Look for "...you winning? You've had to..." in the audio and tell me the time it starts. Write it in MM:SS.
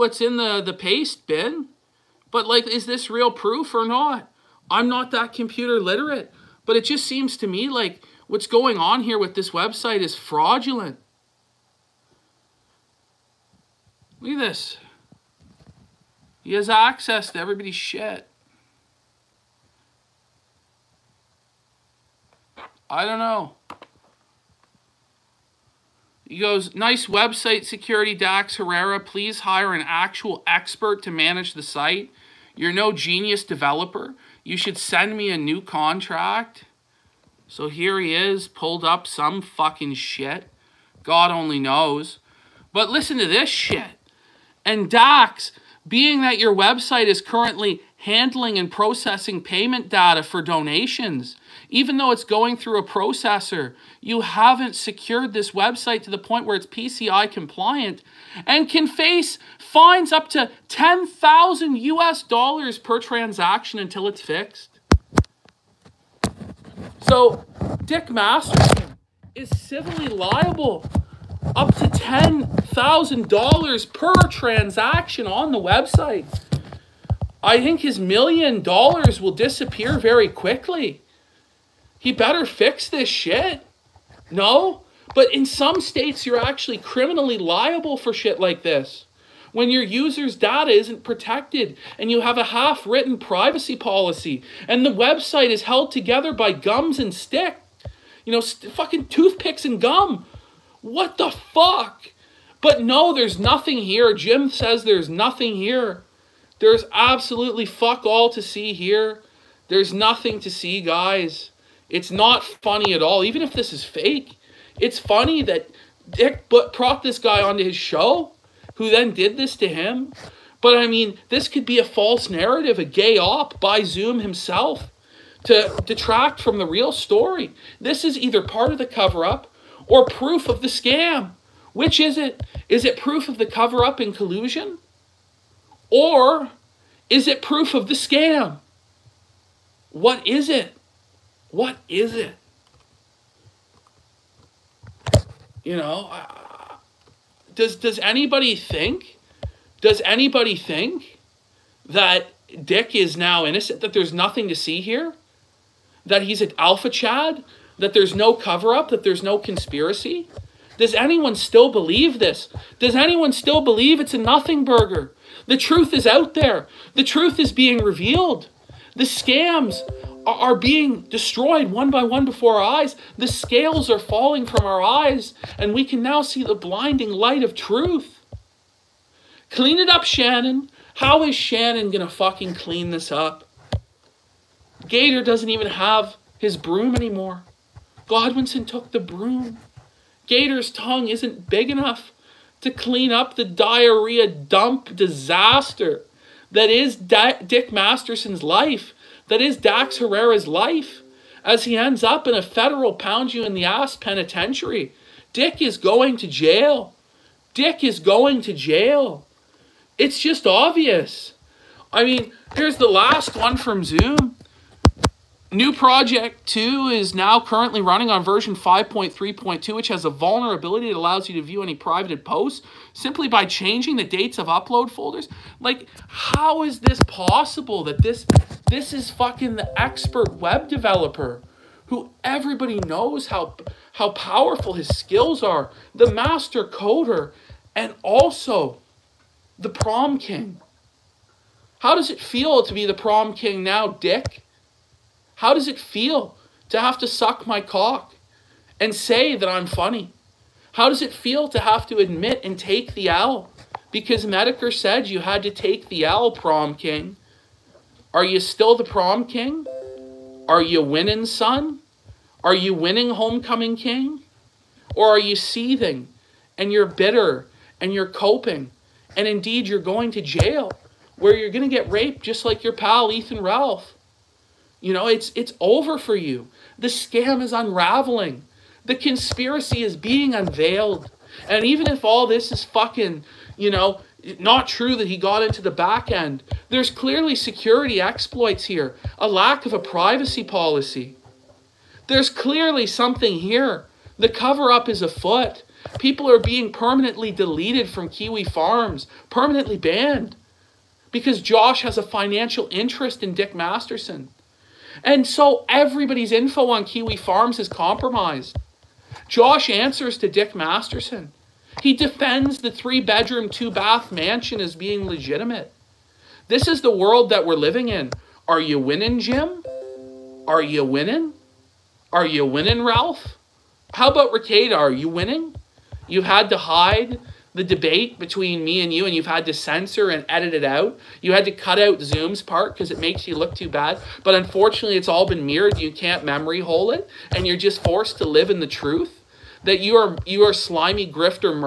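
05:24.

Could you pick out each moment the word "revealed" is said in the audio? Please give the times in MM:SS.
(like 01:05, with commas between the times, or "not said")
02:47.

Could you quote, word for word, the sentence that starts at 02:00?
But I mean, this could be a false narrative, a gay op by Zoom himself to detract from the real story.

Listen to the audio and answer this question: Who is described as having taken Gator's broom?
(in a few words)
Godwinson.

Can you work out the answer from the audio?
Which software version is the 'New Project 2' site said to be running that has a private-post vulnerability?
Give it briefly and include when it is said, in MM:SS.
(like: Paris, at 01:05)
5.3.2, at 03:38.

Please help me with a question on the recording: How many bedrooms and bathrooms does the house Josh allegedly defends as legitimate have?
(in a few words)
three bedroom, two bath.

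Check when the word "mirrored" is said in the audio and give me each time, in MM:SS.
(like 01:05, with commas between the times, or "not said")
05:35.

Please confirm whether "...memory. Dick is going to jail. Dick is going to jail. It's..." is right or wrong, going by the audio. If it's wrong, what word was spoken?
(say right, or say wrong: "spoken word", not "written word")
wrong: "penitentiary", not "memory".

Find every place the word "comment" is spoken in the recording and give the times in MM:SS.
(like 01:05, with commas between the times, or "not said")
not said.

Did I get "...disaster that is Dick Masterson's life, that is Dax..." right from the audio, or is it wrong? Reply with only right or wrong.
right.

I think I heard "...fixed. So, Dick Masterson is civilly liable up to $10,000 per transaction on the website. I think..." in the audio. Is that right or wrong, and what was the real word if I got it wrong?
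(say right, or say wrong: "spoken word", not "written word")
right.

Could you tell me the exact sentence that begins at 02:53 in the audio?
The scales are falling from our eyes, and we can now see the blinding light of truth.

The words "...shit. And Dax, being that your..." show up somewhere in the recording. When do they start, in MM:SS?
00:43.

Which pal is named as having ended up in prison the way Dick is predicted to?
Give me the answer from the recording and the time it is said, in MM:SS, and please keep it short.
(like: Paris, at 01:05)
Ethan Ralph, at 04:33.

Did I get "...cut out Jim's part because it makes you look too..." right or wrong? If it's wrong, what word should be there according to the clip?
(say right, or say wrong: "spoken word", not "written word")
wrong: "Zoom", not "Jim".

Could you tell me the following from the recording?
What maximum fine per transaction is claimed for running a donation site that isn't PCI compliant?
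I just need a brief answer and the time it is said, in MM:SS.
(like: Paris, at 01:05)
$10,000, at 01:00.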